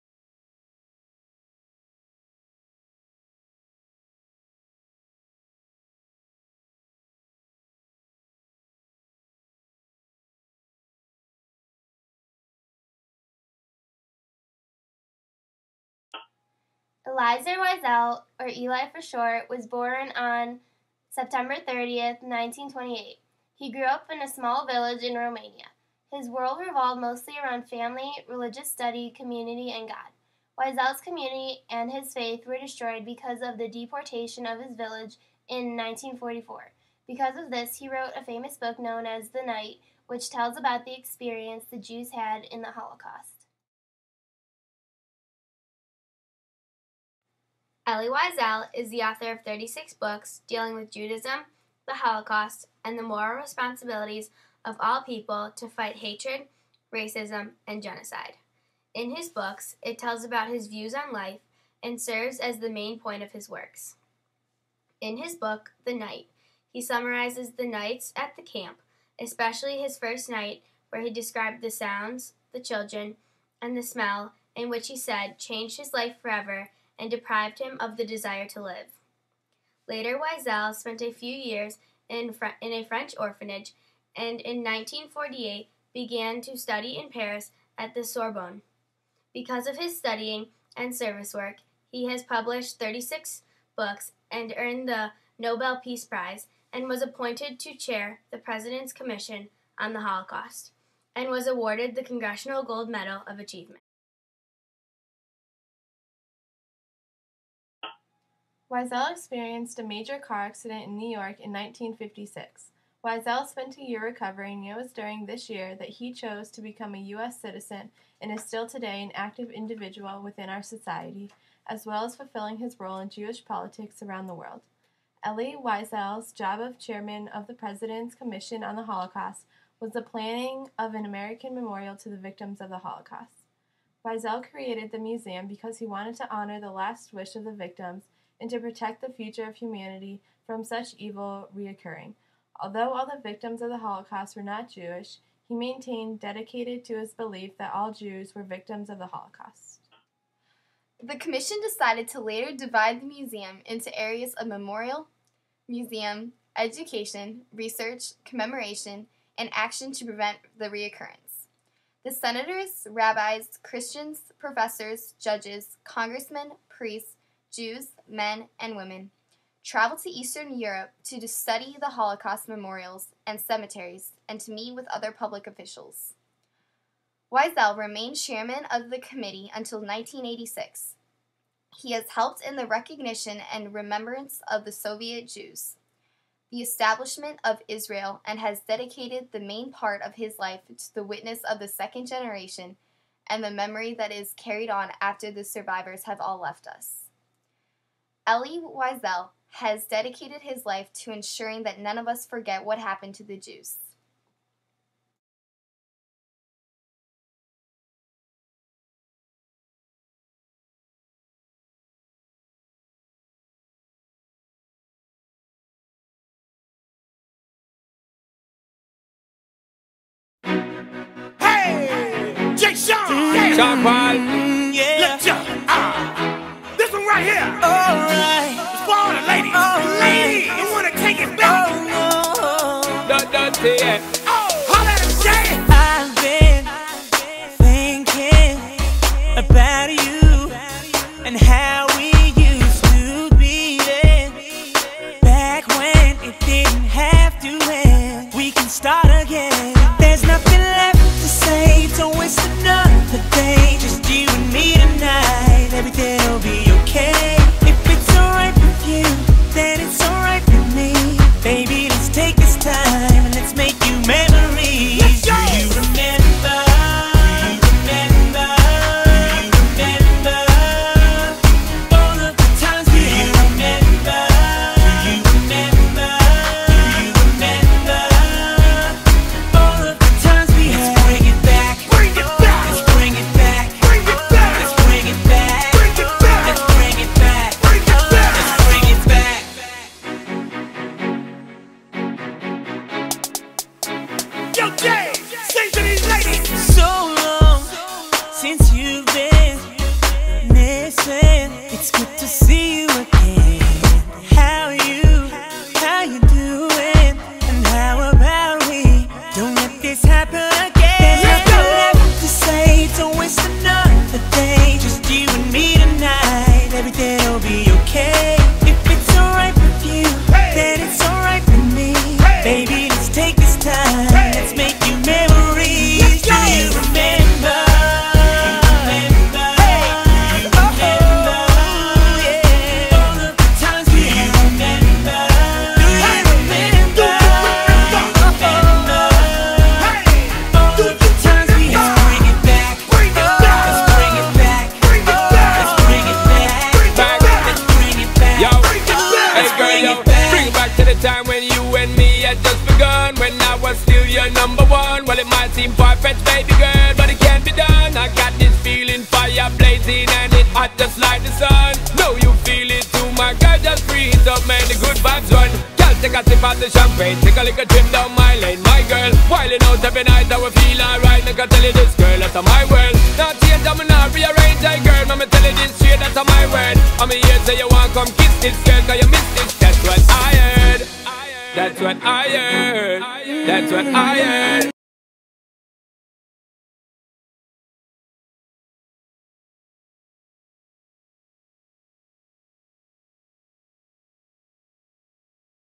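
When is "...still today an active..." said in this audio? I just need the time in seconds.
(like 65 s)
118 s.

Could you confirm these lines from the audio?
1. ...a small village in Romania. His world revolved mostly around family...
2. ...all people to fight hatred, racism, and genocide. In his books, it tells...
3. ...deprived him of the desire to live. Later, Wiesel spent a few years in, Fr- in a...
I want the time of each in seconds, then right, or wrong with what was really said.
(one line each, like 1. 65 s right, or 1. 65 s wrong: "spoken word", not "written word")
1. 24 s right
2. 54 s right
3. 77 s right.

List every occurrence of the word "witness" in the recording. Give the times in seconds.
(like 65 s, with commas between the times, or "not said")
191 s.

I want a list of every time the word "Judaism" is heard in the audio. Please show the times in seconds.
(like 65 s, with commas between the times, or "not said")
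50 s.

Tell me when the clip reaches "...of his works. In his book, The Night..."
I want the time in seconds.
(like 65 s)
63 s.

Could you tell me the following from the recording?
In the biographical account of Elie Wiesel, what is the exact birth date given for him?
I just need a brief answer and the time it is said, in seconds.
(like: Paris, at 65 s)
September 30th, 1928, at 21 s.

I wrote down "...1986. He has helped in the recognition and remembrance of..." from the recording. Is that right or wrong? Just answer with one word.
right.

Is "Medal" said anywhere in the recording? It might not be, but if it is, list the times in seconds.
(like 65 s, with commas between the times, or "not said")
102 s.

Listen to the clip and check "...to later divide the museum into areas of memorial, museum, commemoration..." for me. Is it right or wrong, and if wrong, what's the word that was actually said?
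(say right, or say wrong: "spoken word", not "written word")
wrong: "education", not "commemoration".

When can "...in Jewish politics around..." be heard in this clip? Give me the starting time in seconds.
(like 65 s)
122 s.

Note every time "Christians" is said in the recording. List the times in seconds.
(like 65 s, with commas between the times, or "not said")
163 s.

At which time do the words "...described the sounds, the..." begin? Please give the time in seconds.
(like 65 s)
71 s.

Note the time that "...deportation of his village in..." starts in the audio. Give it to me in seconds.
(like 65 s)
33 s.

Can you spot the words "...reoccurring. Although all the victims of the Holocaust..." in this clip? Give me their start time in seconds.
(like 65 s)
141 s.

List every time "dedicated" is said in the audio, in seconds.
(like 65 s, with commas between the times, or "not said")
146 s, 188 s, 199 s.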